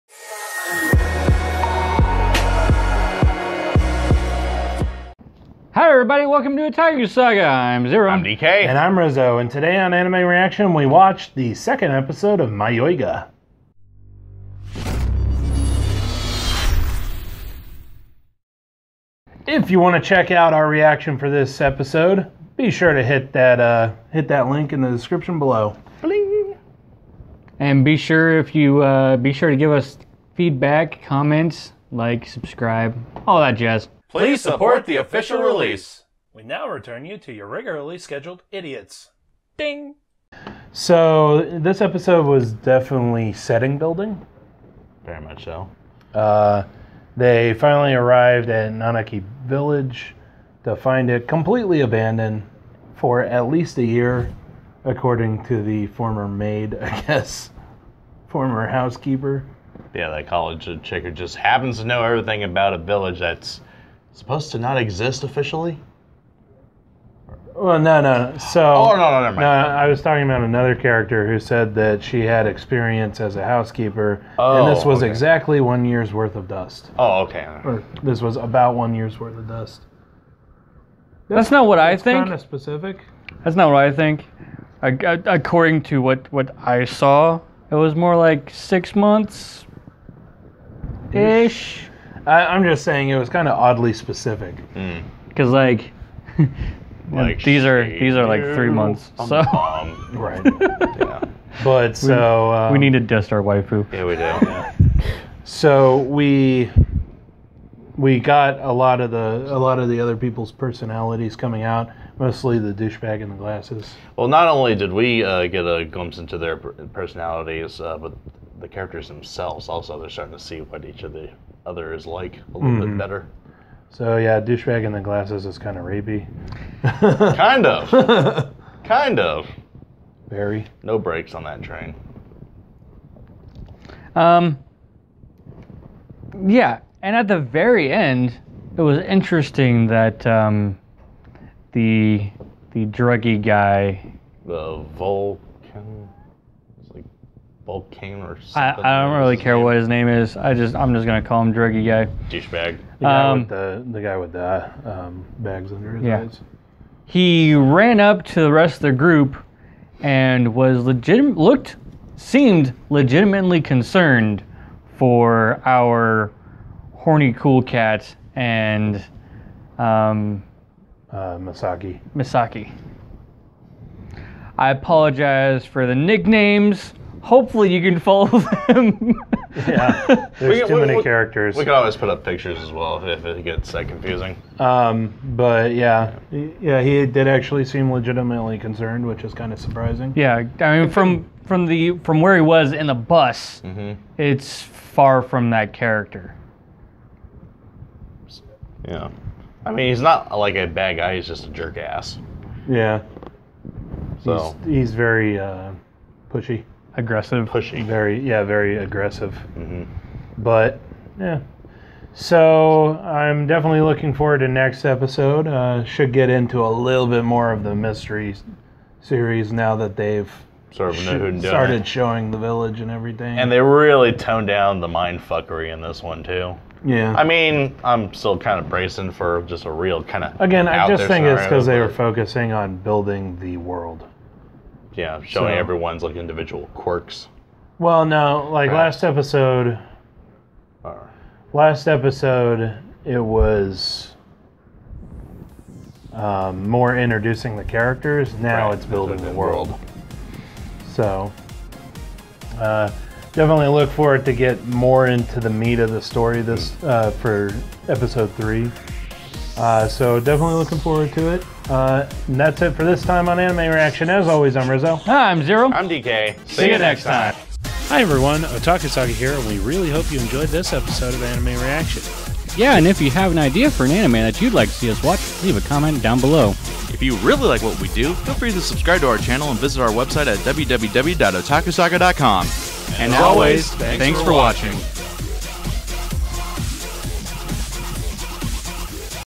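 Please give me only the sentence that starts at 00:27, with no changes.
And be sure if you uh, be sure to give us feedback, comments, like, subscribe, all that jazz.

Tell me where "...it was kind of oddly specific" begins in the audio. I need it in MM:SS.
01:33.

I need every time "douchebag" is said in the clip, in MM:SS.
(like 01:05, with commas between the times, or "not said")
01:52, 02:04, 02:32.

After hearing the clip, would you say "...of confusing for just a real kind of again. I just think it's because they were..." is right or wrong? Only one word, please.
wrong.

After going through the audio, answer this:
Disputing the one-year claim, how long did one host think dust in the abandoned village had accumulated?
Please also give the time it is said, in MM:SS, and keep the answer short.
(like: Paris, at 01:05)
six months, at 01:28.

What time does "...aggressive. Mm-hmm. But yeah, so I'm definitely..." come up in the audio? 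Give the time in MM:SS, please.
03:28.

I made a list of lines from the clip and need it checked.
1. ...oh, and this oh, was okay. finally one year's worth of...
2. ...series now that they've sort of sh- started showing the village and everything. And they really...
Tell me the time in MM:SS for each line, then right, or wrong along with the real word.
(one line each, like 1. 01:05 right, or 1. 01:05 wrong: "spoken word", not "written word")
1. 01:14 wrong: "exactly", not "finally"
2. 03:39 right.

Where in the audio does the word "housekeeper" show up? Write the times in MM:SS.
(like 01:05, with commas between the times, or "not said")
00:58, 01:13.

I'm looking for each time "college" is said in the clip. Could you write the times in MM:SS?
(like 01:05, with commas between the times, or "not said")
01:00.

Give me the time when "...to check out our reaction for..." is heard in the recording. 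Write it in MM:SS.
00:19.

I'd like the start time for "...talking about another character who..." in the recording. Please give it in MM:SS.
01:10.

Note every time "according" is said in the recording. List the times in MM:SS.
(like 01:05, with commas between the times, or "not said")
00:54, 01:25.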